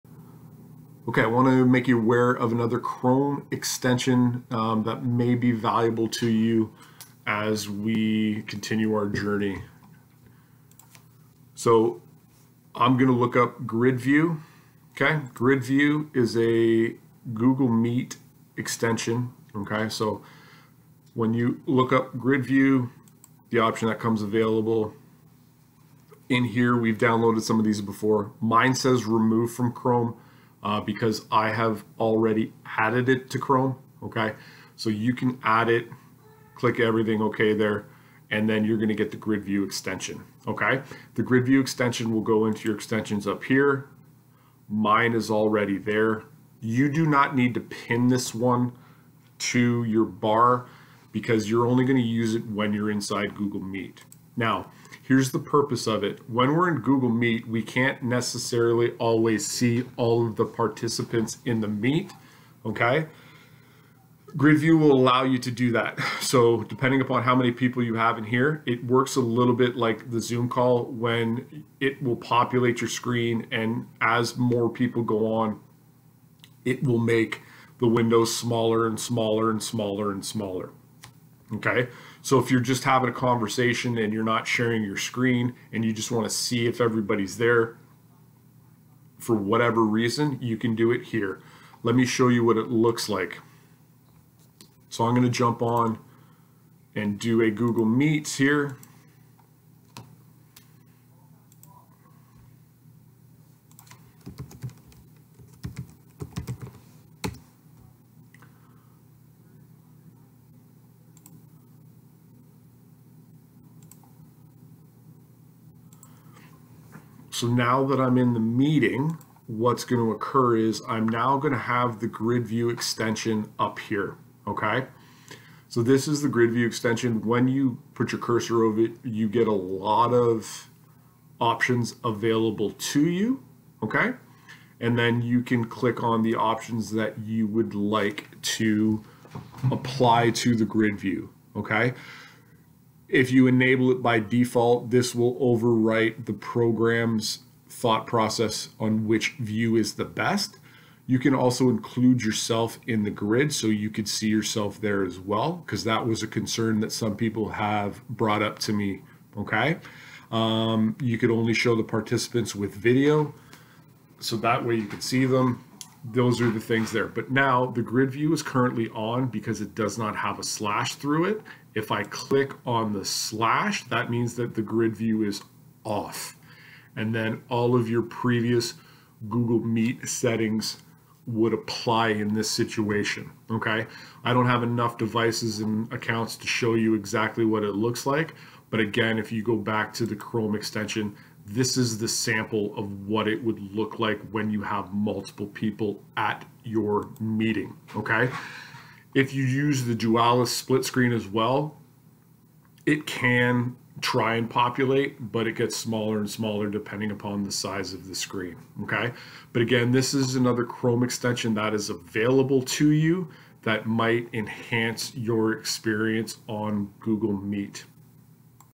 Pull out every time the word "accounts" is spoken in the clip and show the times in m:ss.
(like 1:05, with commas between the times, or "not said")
3:05.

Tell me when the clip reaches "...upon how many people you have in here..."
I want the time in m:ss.
1:07.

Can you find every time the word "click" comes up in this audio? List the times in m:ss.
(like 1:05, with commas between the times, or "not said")
0:36, 2:15, 2:52.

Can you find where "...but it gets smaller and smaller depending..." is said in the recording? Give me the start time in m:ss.
3:25.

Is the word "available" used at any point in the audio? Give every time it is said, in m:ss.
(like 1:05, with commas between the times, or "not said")
0:24, 2:12, 3:31.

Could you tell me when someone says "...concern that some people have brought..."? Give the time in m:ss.
2:36.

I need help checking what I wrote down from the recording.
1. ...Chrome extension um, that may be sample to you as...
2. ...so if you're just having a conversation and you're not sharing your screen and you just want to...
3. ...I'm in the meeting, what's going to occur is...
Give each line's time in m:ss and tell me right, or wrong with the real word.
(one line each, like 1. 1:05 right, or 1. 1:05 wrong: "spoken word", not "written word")
1. 0:02 wrong: "valuable", not "sample"
2. 1:22 right
3. 1:57 right.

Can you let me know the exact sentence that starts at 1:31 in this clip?
Let me show you what it looks like.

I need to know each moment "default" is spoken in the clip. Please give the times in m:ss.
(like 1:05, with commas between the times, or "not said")
2:24.